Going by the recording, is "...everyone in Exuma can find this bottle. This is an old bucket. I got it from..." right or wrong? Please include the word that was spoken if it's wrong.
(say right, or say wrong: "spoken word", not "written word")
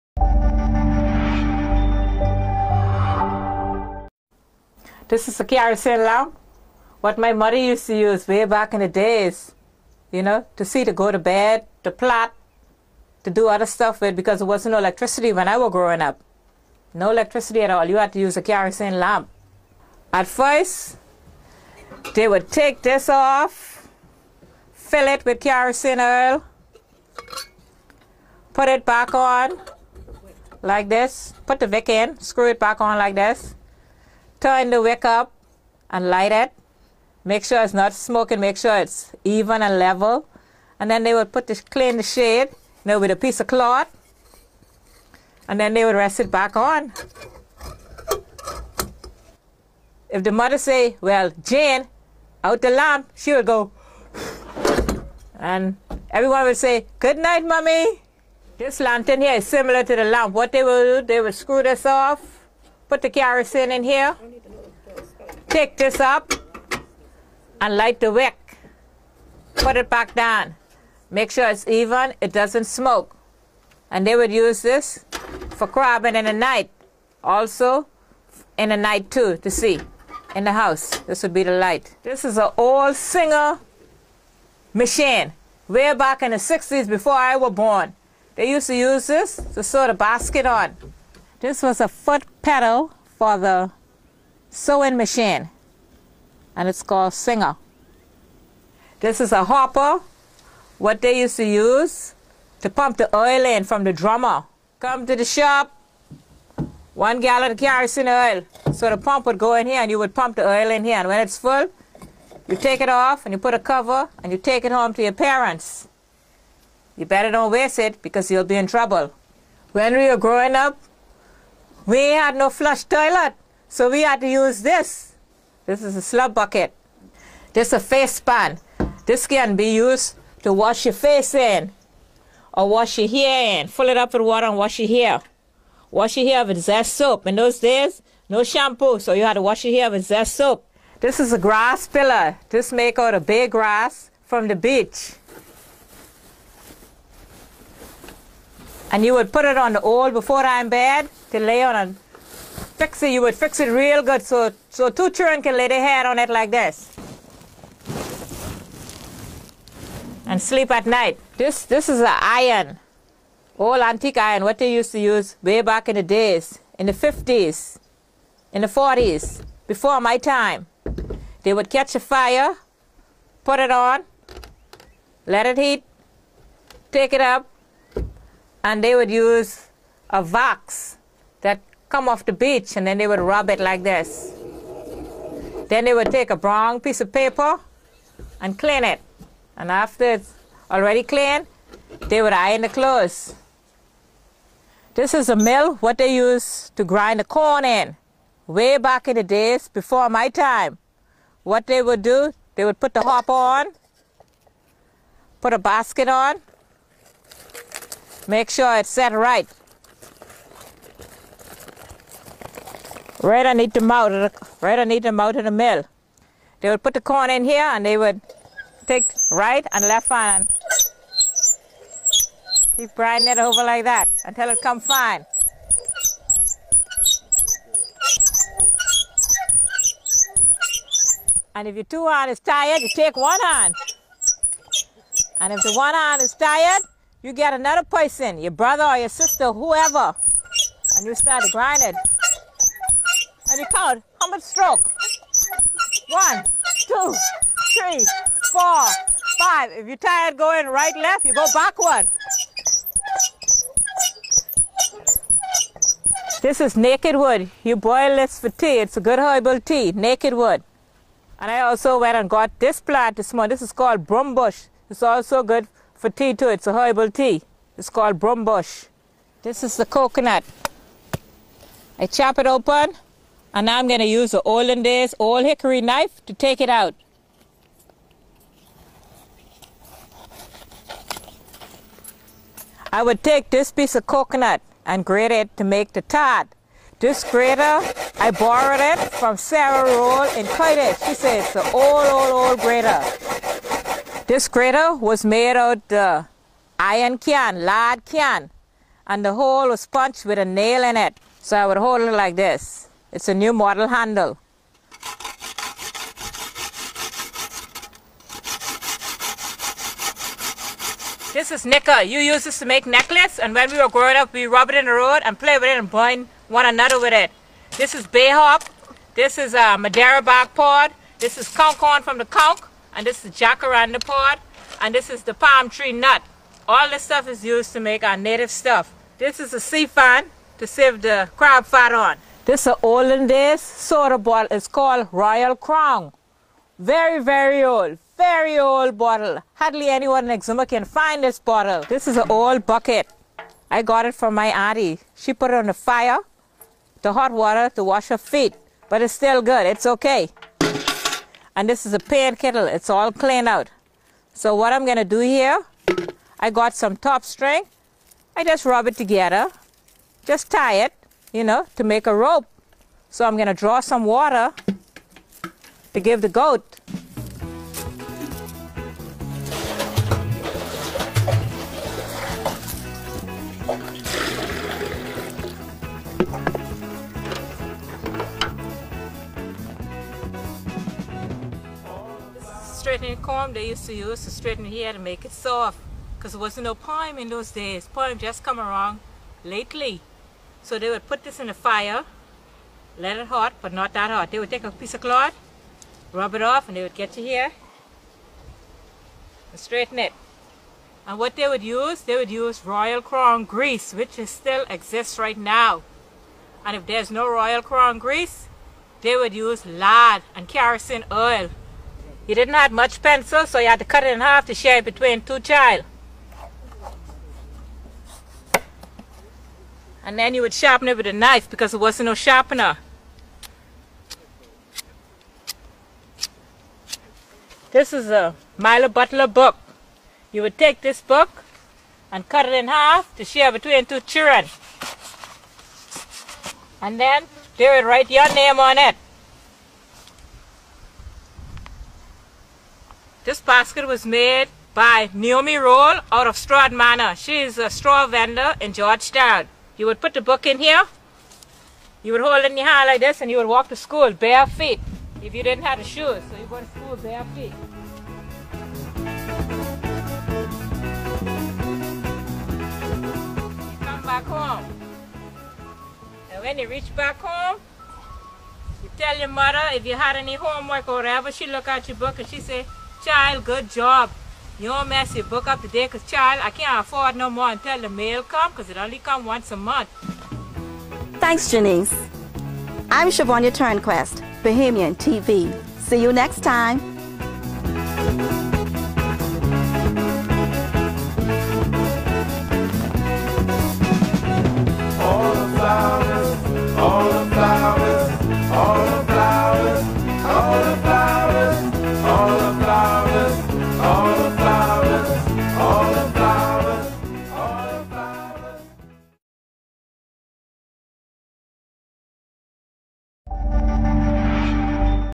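wrong: "anyone", not "everyone".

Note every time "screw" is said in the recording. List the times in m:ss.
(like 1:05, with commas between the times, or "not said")
0:32, 1:01.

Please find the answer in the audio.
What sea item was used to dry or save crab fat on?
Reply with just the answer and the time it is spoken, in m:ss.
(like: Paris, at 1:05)
Sea fan, at 5:29.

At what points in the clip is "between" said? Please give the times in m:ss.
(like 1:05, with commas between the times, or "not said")
6:54, 7:13.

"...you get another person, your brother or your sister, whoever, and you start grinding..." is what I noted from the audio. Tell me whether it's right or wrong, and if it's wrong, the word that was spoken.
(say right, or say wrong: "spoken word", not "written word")
right.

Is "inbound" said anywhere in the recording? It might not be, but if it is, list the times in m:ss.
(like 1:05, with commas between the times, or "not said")
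not said.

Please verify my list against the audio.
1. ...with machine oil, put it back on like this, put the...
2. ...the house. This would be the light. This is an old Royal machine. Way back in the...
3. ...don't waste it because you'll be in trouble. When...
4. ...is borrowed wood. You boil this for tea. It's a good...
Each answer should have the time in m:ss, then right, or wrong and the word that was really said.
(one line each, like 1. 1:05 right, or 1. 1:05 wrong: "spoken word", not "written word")
1. 0:25 wrong: "kerosene", not "machine"
2. 1:20 wrong: "Singer", not "Royal"
3. 1:57 right
4. 4:16 wrong: "naked", not "borrowed".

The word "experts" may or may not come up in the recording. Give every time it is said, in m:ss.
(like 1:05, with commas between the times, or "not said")
not said.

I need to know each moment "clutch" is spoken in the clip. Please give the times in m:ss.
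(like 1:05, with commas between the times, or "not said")
not said.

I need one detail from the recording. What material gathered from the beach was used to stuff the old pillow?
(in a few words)
Bay grass.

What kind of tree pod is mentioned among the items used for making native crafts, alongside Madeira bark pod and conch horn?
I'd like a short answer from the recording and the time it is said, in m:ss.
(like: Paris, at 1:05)
Jacaranda pod, at 5:23.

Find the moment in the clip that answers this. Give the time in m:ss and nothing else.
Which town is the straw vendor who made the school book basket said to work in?
7:28.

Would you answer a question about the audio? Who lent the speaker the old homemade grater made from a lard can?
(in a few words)
Sarah Roll.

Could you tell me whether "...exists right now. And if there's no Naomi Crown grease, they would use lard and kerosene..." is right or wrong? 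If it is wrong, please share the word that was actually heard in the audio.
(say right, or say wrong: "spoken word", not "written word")
wrong: "Royal", not "Naomi".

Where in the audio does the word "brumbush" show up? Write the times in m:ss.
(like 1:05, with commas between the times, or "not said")
4:24, 4:28.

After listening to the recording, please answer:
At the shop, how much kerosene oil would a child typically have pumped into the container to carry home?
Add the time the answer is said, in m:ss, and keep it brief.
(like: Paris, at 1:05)
1 gallon, at 1:46.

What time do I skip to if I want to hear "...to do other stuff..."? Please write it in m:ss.
0:13.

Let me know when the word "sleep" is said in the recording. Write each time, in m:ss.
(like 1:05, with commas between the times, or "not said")
2:40.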